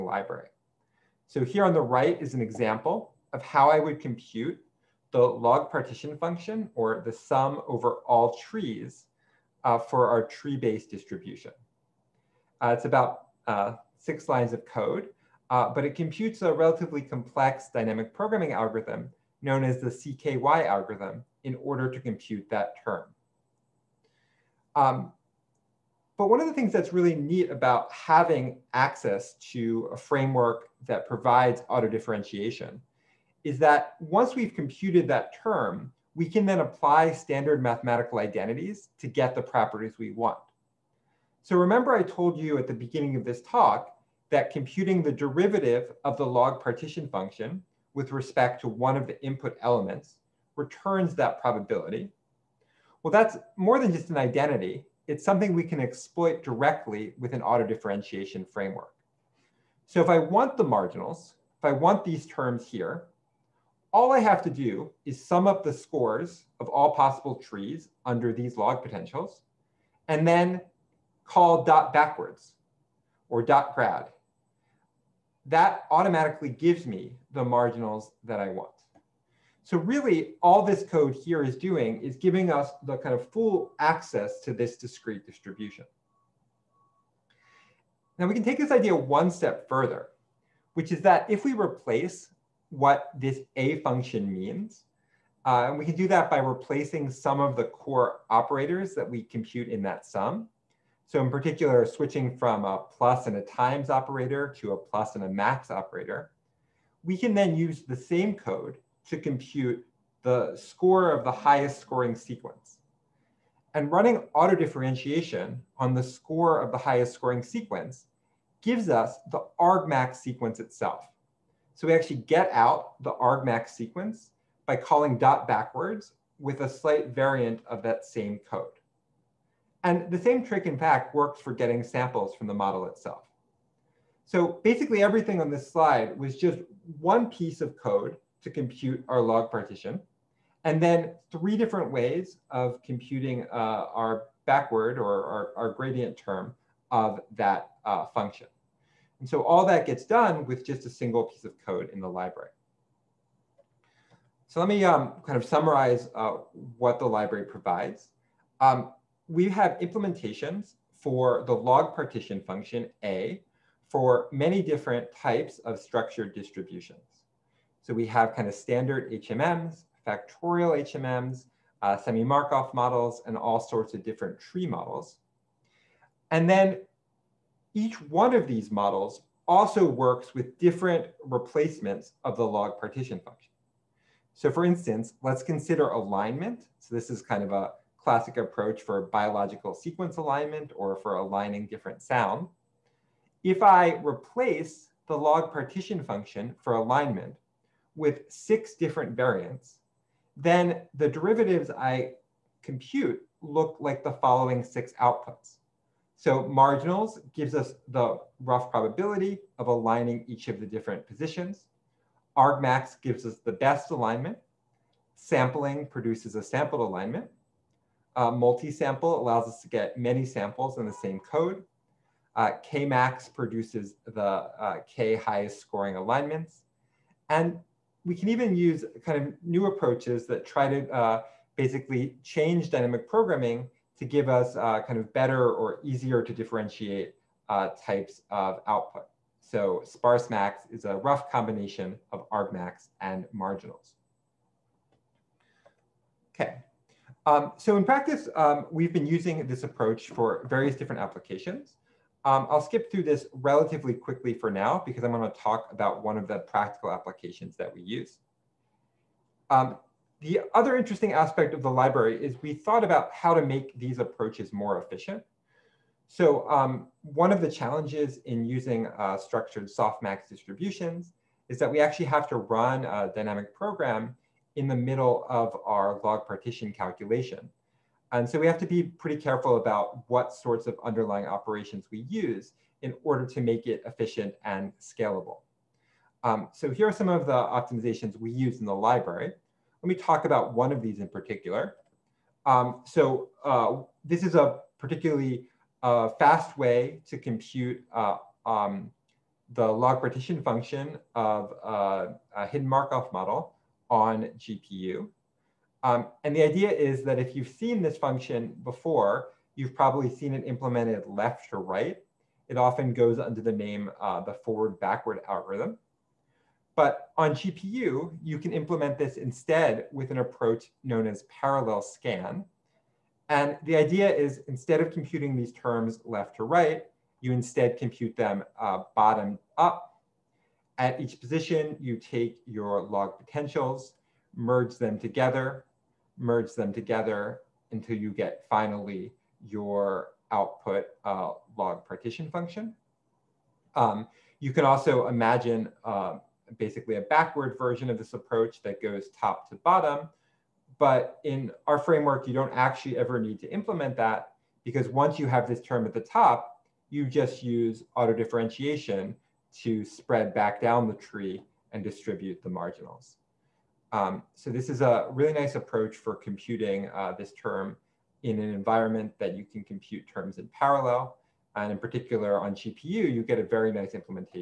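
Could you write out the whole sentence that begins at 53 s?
Well, that's more than just an identity.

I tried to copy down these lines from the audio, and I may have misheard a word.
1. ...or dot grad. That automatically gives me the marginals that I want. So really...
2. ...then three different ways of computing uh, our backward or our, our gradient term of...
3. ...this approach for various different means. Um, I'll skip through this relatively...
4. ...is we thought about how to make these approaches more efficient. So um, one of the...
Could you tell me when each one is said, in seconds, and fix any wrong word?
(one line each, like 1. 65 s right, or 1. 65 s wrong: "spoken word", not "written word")
1. 73 s right
2. 140 s right
3. 249 s wrong: "applications", not "means"
4. 262 s right.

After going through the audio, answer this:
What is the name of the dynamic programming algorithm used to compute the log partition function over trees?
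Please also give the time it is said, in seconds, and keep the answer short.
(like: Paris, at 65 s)
CKY algorithm, at 19 s.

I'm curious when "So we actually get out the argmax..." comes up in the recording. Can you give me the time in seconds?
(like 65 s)
121 s.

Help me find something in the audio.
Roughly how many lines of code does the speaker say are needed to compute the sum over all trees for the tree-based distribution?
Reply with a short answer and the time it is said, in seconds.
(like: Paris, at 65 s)
6, at 13 s.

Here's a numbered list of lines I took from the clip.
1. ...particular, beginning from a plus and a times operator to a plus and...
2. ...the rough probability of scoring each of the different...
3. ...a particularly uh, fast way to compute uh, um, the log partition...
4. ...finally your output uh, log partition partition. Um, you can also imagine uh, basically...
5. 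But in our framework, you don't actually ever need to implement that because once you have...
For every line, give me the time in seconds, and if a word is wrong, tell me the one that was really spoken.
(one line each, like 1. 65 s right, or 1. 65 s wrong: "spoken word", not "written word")
1. 101 s wrong: "switching", not "beginning"
2. 207 s wrong: "aligning", not "scoring"
3. 294 s right
4. 338 s wrong: "function", not "partition"
5. 350 s right.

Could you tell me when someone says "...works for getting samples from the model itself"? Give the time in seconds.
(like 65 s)
131 s.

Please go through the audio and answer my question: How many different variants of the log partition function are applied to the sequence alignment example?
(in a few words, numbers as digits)
6.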